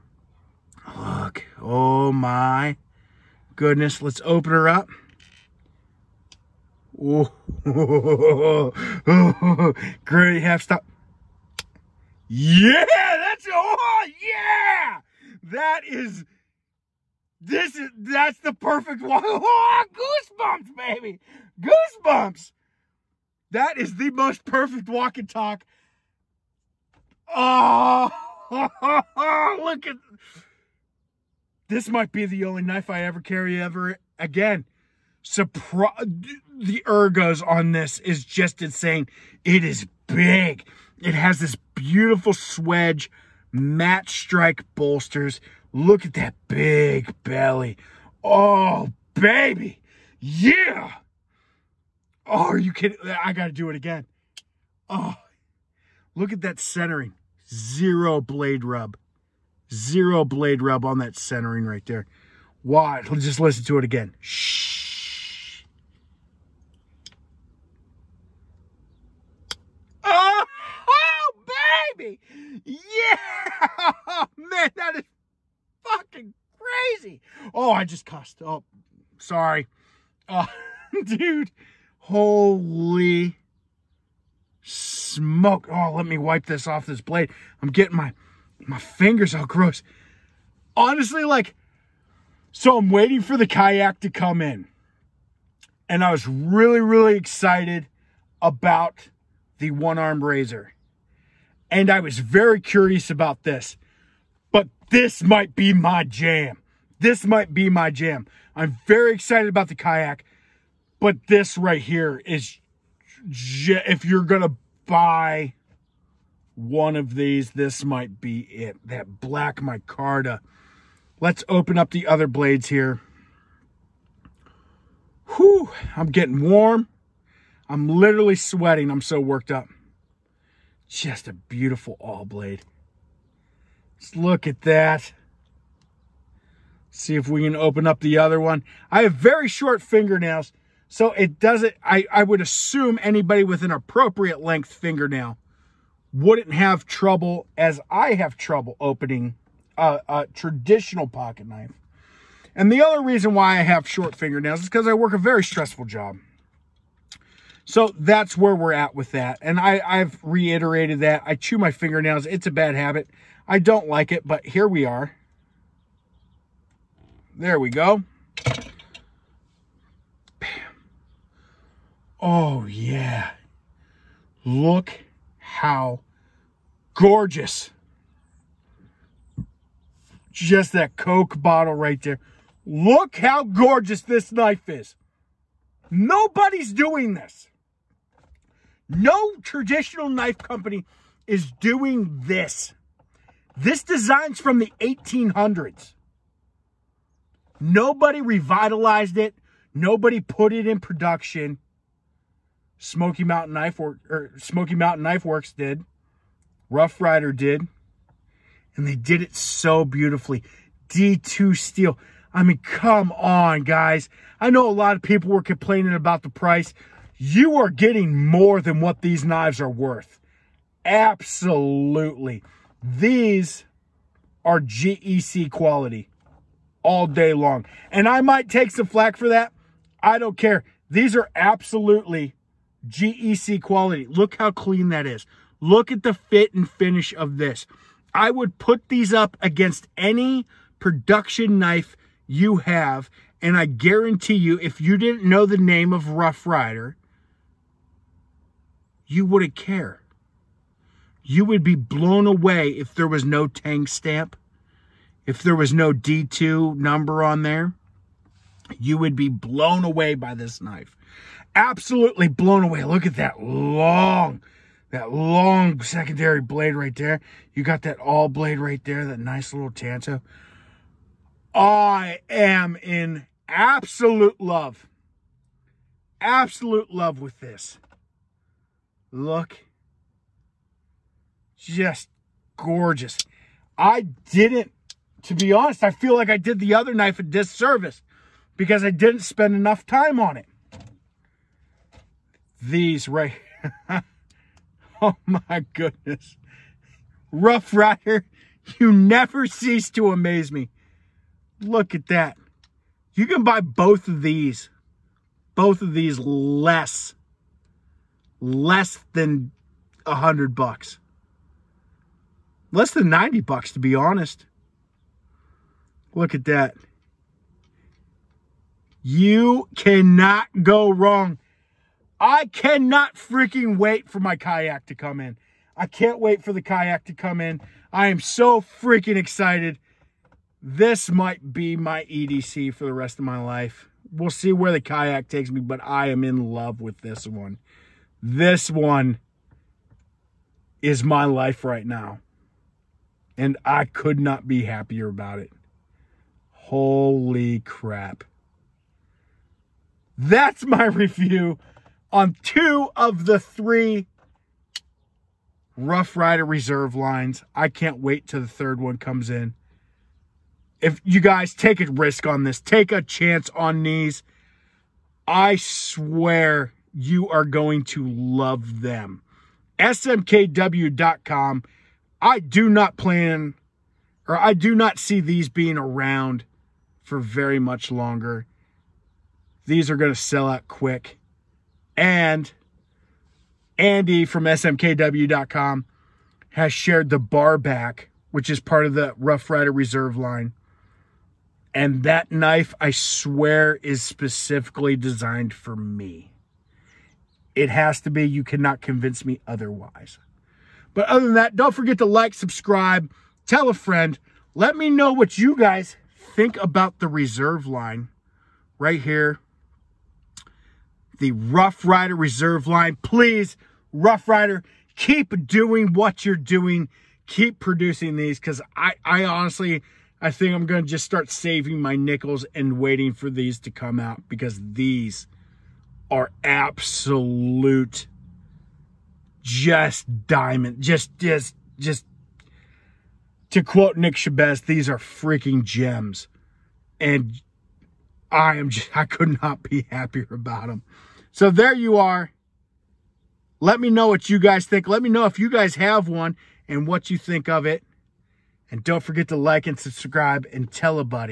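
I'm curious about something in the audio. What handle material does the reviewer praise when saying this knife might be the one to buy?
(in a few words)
Black micarta.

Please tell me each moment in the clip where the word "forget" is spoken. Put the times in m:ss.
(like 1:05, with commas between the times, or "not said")
6:41, 7:29.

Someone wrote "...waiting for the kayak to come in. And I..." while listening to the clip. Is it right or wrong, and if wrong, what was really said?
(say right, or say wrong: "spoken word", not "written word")
right.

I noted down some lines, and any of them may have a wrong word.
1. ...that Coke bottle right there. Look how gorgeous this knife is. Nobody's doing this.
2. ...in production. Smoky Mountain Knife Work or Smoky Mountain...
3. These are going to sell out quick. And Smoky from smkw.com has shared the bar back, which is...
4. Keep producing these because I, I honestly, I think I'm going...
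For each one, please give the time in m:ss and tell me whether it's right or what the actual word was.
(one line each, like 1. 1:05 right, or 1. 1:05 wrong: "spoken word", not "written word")
1. 3:00 right
2. 3:20 right
3. 6:19 wrong: "Andy", not "Smoky"
4. 6:57 right.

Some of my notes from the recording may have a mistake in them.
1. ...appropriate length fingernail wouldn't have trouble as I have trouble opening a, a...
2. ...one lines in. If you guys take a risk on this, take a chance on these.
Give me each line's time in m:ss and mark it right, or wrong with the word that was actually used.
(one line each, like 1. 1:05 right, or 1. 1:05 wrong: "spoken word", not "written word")
1. 2:23 right
2. 5:58 wrong: "comes", not "lines".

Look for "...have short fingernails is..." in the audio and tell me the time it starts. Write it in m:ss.
2:33.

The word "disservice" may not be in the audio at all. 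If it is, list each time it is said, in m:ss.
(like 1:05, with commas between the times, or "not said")
4:47.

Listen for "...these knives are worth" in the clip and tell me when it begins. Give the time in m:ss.
3:39.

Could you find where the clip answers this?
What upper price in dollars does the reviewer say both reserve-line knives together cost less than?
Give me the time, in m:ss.
5:13.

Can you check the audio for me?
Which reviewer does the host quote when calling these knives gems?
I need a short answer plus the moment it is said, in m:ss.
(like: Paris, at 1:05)
Nick Shabazz, at 7:13.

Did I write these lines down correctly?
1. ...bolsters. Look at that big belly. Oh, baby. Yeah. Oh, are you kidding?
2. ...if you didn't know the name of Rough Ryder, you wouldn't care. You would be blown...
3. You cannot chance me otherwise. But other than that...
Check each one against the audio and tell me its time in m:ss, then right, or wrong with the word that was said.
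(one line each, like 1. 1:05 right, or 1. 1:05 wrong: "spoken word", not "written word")
1. 0:44 right
2. 4:04 right
3. 6:38 wrong: "convince", not "chance".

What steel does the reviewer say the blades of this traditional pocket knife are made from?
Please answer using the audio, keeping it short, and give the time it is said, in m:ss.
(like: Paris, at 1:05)
D2, at 3:30.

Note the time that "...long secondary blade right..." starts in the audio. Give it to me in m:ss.
4:25.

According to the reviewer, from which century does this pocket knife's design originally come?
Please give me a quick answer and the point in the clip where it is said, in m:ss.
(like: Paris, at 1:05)
1800s, at 3:14.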